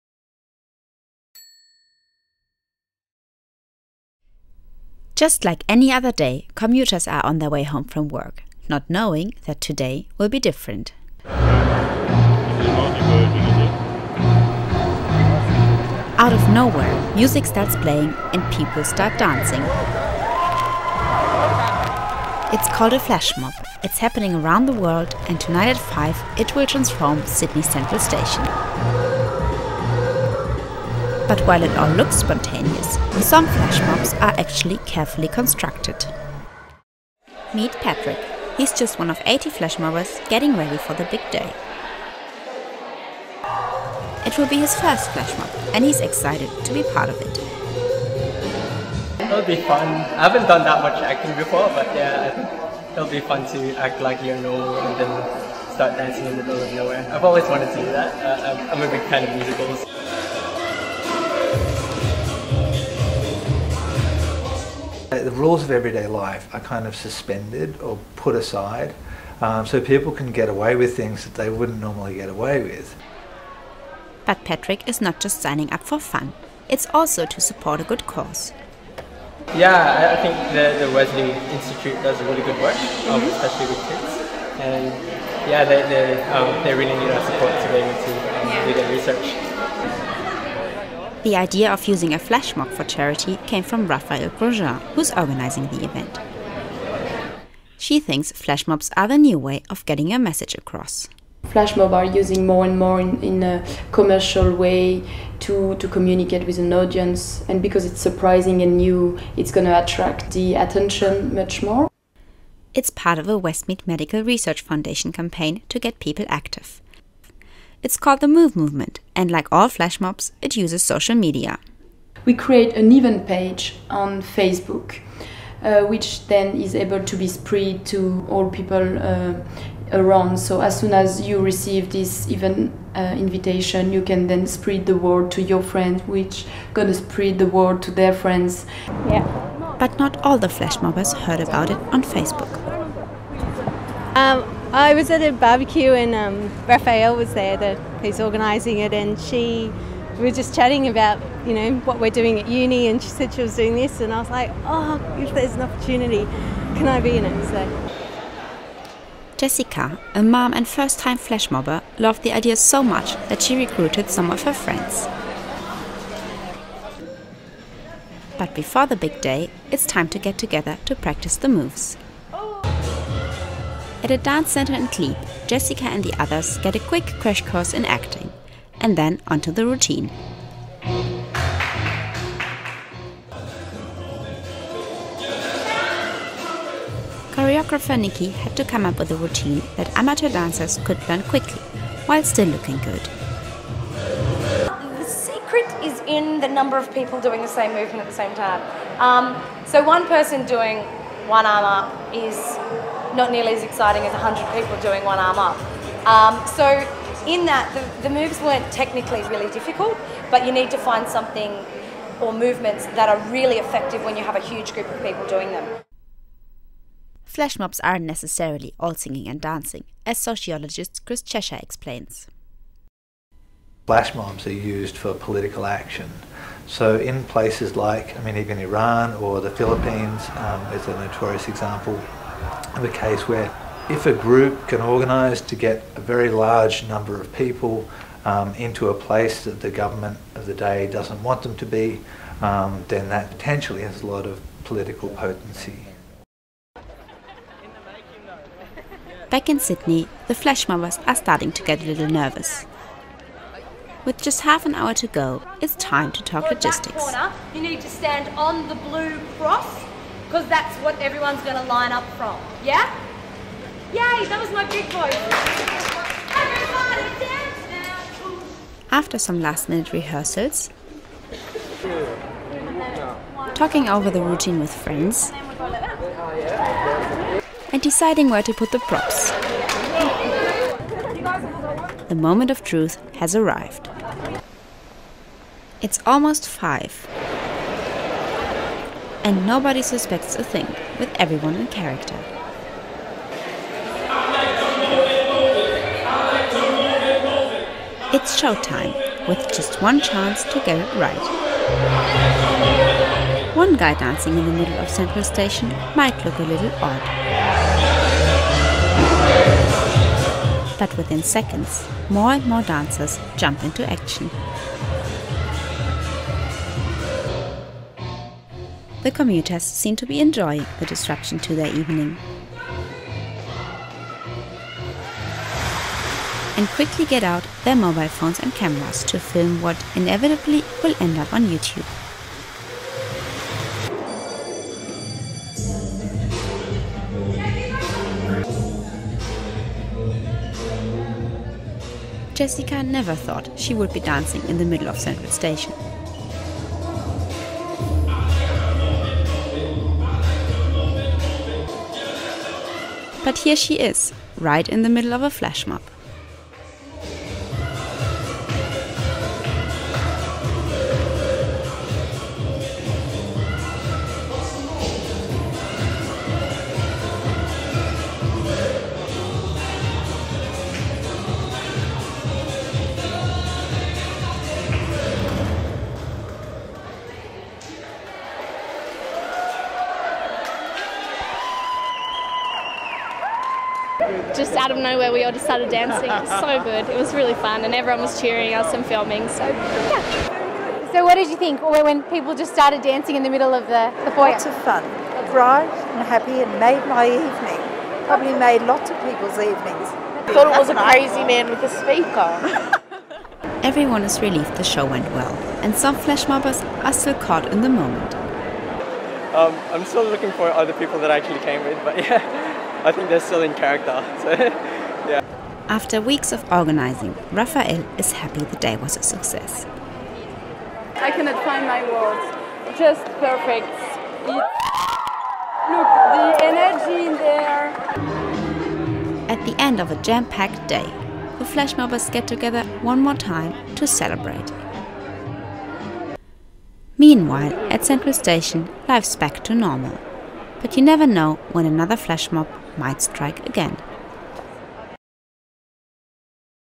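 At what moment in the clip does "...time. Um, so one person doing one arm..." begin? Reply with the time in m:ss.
3:18.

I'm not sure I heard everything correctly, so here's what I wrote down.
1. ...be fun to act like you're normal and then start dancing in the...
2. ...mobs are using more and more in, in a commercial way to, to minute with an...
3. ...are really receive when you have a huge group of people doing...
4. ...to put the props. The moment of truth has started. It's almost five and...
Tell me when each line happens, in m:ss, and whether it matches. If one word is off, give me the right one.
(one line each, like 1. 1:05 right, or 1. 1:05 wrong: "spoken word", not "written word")
1. 0:53 right
2. 1:41 wrong: "communicate", not "minute"
3. 3:33 wrong: "effective", not "receive"
4. 4:38 wrong: "arrived", not "started".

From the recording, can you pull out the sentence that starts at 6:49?
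Um, I'm still looking for other people that I actually came with, but yeah, I think they're still in character.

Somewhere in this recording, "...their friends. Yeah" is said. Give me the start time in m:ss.
2:17.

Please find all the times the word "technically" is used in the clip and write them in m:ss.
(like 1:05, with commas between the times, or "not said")
3:28.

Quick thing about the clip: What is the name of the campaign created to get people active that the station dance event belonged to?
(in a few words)
Move Movement.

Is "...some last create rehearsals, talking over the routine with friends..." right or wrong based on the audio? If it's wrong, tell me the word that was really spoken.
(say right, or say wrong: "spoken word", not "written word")
wrong: "minute", not "create".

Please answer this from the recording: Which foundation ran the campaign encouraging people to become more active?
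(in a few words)
Westmead Medical Research Foundation.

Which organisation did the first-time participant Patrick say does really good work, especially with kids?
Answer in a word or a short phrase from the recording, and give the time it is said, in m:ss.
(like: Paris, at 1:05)
Wesley Institute, at 1:20.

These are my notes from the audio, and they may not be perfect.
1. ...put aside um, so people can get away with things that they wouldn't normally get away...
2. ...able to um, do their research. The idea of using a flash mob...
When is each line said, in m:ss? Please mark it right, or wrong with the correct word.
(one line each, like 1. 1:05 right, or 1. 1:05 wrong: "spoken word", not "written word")
1. 1:08 right
2. 1:27 right.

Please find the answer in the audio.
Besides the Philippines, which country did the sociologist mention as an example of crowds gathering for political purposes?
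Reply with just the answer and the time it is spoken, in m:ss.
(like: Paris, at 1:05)
Iran, at 3:48.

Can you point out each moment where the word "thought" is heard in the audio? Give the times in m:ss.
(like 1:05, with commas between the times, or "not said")
5:43, 6:40.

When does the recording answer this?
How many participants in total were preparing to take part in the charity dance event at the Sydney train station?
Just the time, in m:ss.
0:39.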